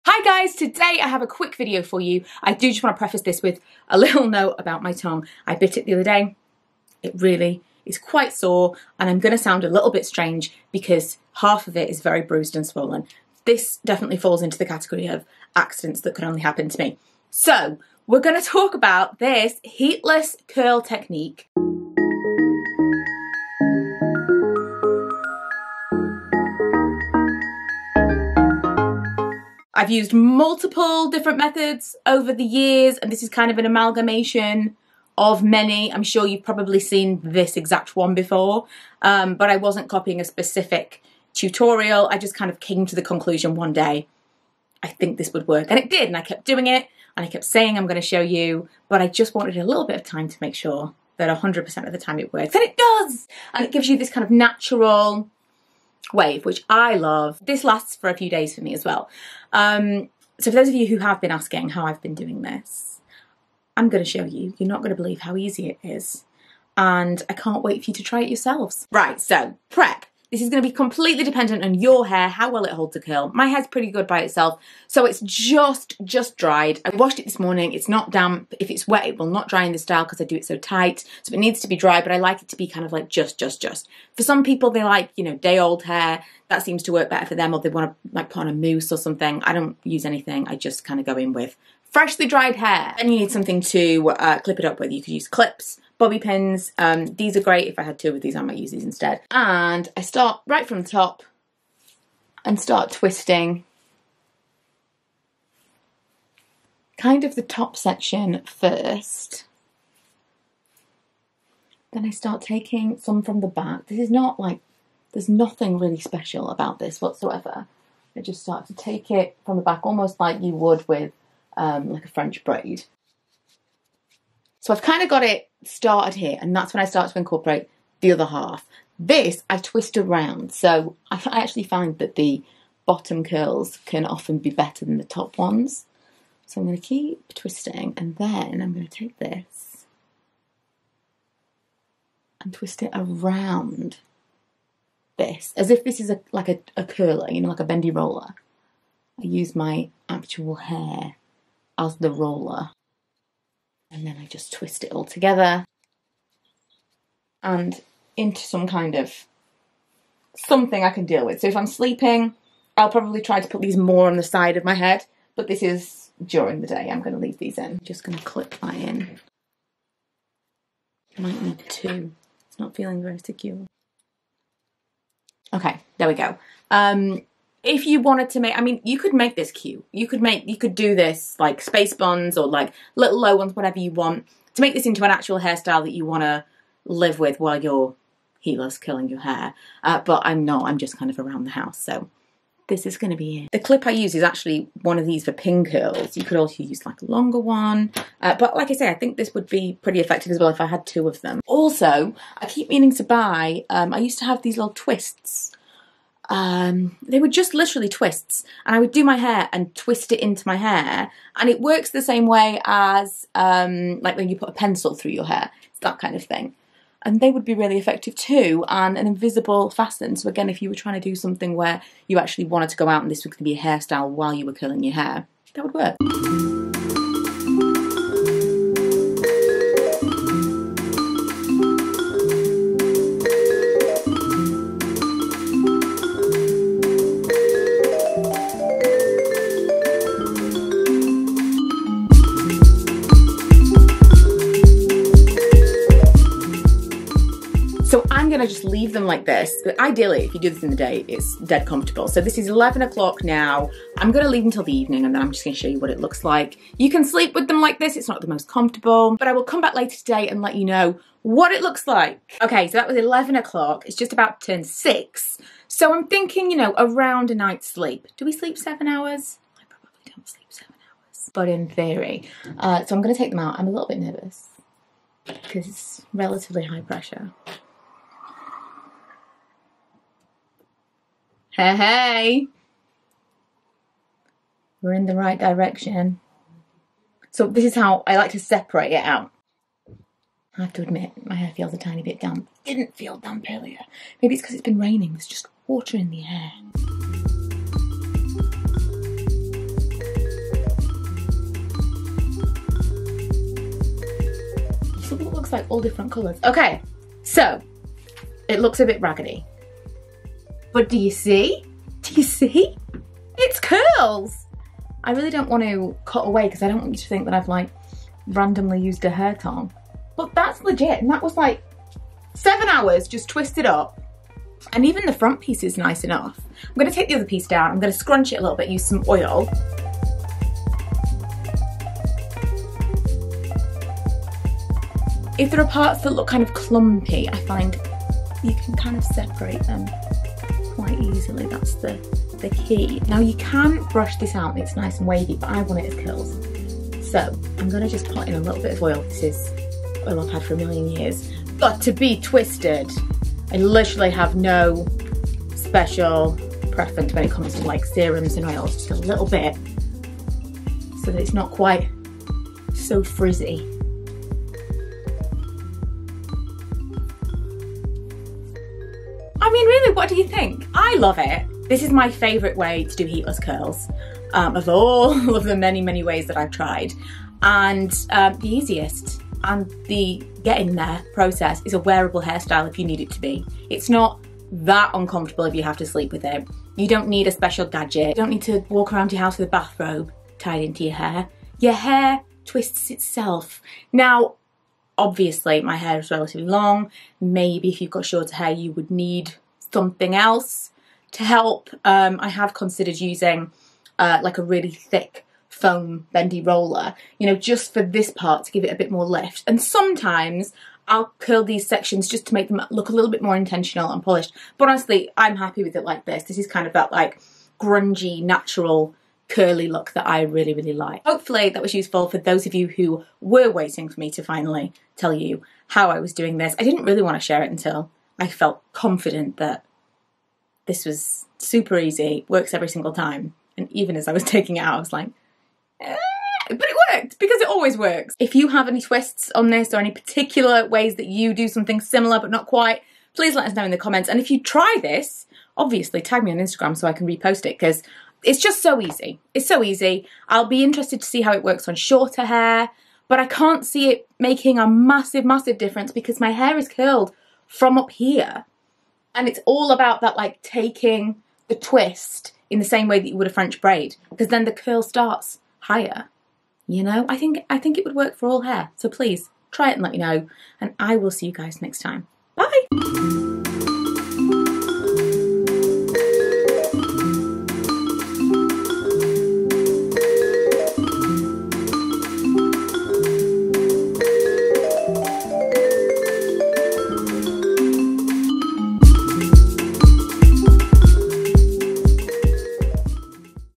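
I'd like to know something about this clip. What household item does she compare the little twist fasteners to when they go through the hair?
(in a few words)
a pencil.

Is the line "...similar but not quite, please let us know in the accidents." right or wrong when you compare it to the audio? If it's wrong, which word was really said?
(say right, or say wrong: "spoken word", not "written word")
wrong: "comments", not "accidents".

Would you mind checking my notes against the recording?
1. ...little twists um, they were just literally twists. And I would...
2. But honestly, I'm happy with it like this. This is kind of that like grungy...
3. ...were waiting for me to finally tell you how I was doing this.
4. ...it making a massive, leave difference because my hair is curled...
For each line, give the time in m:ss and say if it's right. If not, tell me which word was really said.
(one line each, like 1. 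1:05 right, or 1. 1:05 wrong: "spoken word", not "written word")
1. 3:24 right
2. 6:54 right
3. 7:03 right
4. 7:33 wrong: "massive", not "leave".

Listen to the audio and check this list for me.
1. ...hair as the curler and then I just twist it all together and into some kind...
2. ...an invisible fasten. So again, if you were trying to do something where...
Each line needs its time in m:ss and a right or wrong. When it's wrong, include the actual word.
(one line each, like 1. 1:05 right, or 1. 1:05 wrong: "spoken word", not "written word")
1. 2:30 wrong: "roller", not "curler"
2. 3:38 right.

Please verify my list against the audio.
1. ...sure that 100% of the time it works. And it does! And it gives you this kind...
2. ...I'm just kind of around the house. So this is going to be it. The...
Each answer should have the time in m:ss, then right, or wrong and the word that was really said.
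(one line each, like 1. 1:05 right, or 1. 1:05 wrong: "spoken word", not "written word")
1. 0:50 right
2. 3:10 right.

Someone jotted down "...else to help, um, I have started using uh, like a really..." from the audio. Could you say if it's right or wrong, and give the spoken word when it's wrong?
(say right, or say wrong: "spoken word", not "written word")
wrong: "considered", not "started".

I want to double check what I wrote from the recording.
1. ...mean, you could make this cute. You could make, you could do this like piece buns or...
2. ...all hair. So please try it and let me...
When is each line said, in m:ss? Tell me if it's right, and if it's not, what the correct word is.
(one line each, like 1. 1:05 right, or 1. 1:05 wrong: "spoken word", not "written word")
1. 2:58 wrong: "space", not "piece"
2. 7:48 right.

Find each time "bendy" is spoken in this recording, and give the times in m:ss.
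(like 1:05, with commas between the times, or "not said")
2:27, 6:46.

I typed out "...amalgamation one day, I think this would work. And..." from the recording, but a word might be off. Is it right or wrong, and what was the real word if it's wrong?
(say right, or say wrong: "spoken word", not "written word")
wrong: "conclusion", not "amalgamation".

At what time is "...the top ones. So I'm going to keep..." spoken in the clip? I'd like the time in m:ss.
2:14.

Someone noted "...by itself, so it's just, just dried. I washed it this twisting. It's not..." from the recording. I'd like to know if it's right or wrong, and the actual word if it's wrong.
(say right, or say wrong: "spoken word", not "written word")
wrong: "morning", not "twisting".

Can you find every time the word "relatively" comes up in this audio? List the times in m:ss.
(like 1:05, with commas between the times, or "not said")
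4:36, 6:36.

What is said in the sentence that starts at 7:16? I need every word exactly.
but it worked because it always works.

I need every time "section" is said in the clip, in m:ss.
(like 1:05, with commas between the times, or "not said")
1:47, 6:51.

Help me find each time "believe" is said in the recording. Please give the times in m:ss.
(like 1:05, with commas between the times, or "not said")
1:05.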